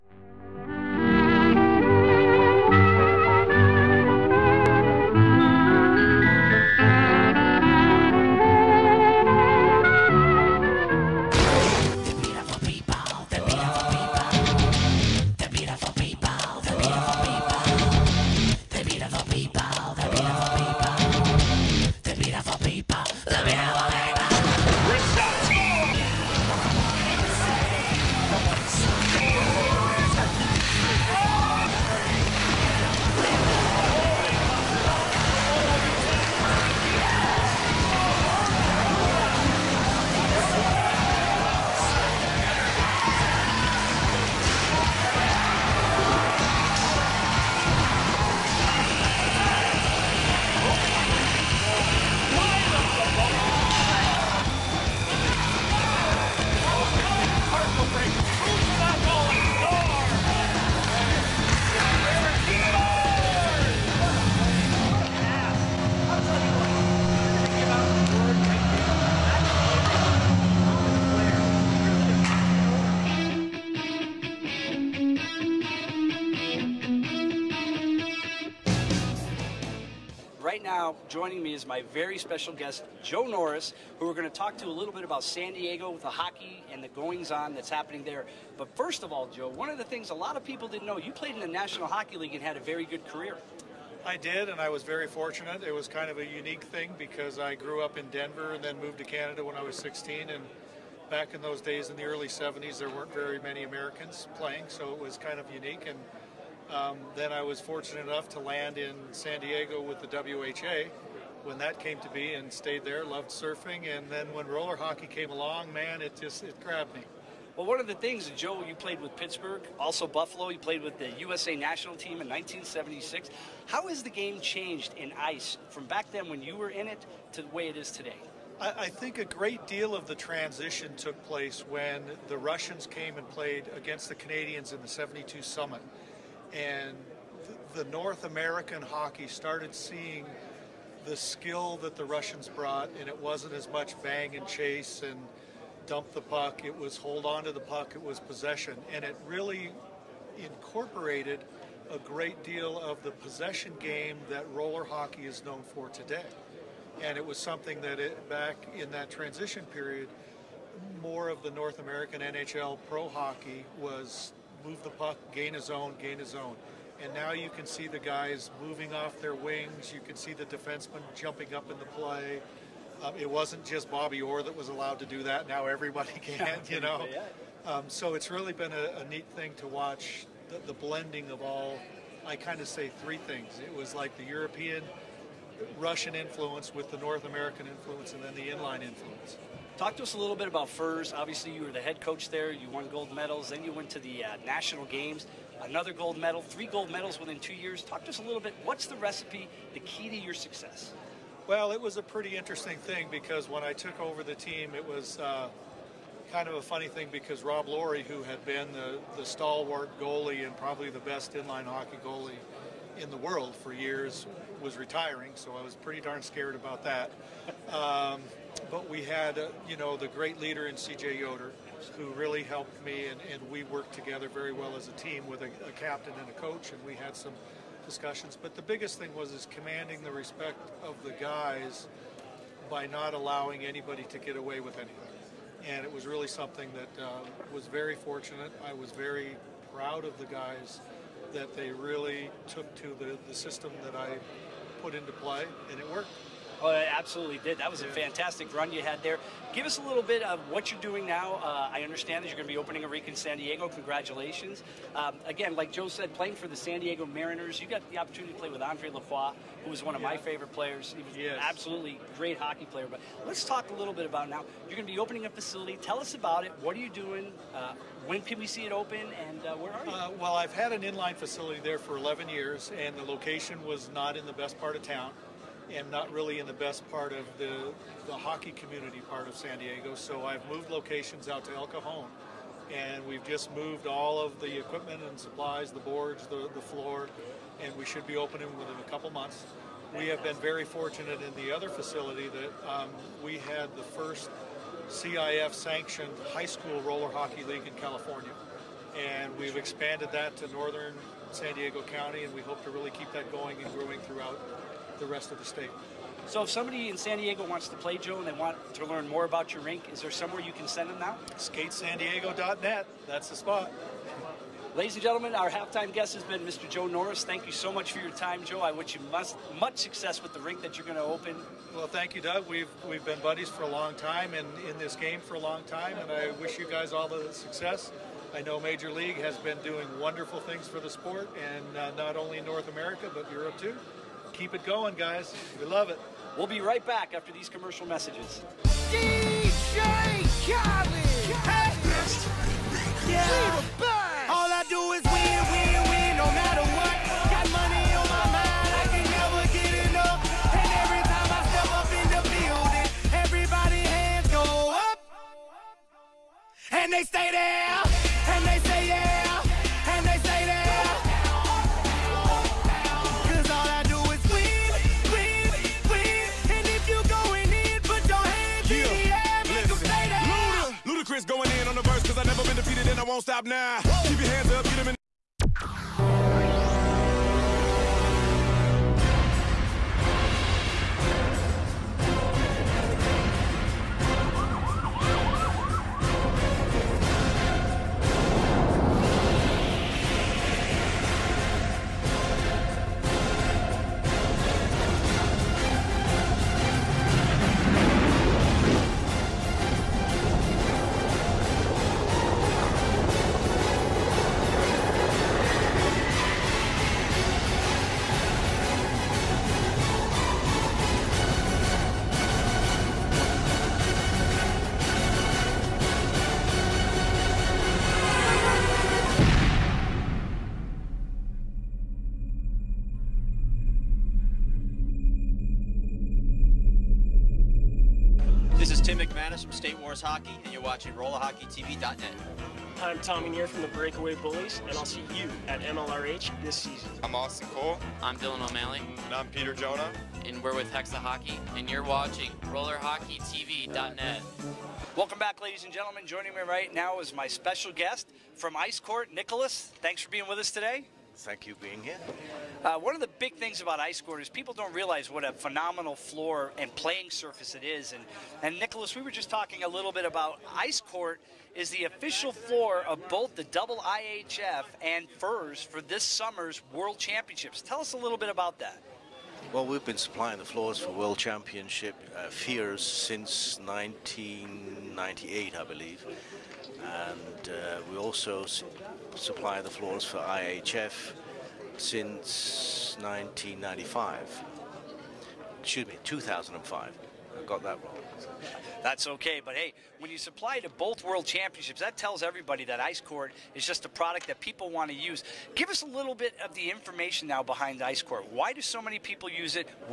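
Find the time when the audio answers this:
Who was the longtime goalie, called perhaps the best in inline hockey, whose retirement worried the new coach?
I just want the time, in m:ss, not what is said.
3:27.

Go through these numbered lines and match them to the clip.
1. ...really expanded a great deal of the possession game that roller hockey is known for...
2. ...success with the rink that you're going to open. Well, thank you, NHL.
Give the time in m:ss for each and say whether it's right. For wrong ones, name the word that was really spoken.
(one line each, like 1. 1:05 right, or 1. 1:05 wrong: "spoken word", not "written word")
1. 2:29 wrong: "incorporated", not "expanded"
2. 5:19 wrong: "Doug", not "NHL".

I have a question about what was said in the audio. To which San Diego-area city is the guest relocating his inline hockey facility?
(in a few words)
El Cajon.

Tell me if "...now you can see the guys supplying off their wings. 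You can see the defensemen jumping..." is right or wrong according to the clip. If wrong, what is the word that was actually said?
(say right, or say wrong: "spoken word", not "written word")
wrong: "moving", not "supplying".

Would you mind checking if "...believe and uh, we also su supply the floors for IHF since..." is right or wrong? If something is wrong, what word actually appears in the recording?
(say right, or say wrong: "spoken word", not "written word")
right.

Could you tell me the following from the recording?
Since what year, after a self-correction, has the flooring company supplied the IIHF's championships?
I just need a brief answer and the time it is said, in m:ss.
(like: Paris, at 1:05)
2005, at 8:06.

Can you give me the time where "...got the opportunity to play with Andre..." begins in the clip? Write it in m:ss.
4:17.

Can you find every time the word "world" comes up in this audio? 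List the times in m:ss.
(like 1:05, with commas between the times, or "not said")
3:33, 7:46, 7:50, 8:11.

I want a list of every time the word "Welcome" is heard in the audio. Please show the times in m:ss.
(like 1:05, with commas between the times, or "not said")
7:24.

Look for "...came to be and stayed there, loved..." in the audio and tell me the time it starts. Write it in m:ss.
1:51.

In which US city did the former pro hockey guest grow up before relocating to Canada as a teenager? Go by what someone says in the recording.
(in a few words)
Denver.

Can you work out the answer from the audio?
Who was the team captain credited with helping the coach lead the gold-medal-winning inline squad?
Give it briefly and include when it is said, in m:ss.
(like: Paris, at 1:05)
C.J. Yoder, at 3:40.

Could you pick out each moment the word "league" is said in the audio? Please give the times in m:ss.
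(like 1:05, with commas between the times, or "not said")
1:32, 4:57, 5:28.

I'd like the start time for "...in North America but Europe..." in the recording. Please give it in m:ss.
5:32.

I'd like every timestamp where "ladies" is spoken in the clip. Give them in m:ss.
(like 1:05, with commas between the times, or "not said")
5:14, 7:25.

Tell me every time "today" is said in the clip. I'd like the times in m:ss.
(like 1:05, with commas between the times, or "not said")
2:07, 2:35, 7:30.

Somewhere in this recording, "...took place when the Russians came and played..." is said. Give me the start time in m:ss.
2:10.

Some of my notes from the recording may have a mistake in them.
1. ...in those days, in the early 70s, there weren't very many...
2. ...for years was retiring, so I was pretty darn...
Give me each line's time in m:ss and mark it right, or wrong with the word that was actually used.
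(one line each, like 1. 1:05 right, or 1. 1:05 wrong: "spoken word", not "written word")
1. 1:41 right
2. 3:33 right.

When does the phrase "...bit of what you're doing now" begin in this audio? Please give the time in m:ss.
4:10.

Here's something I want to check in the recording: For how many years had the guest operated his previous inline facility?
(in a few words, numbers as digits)
11.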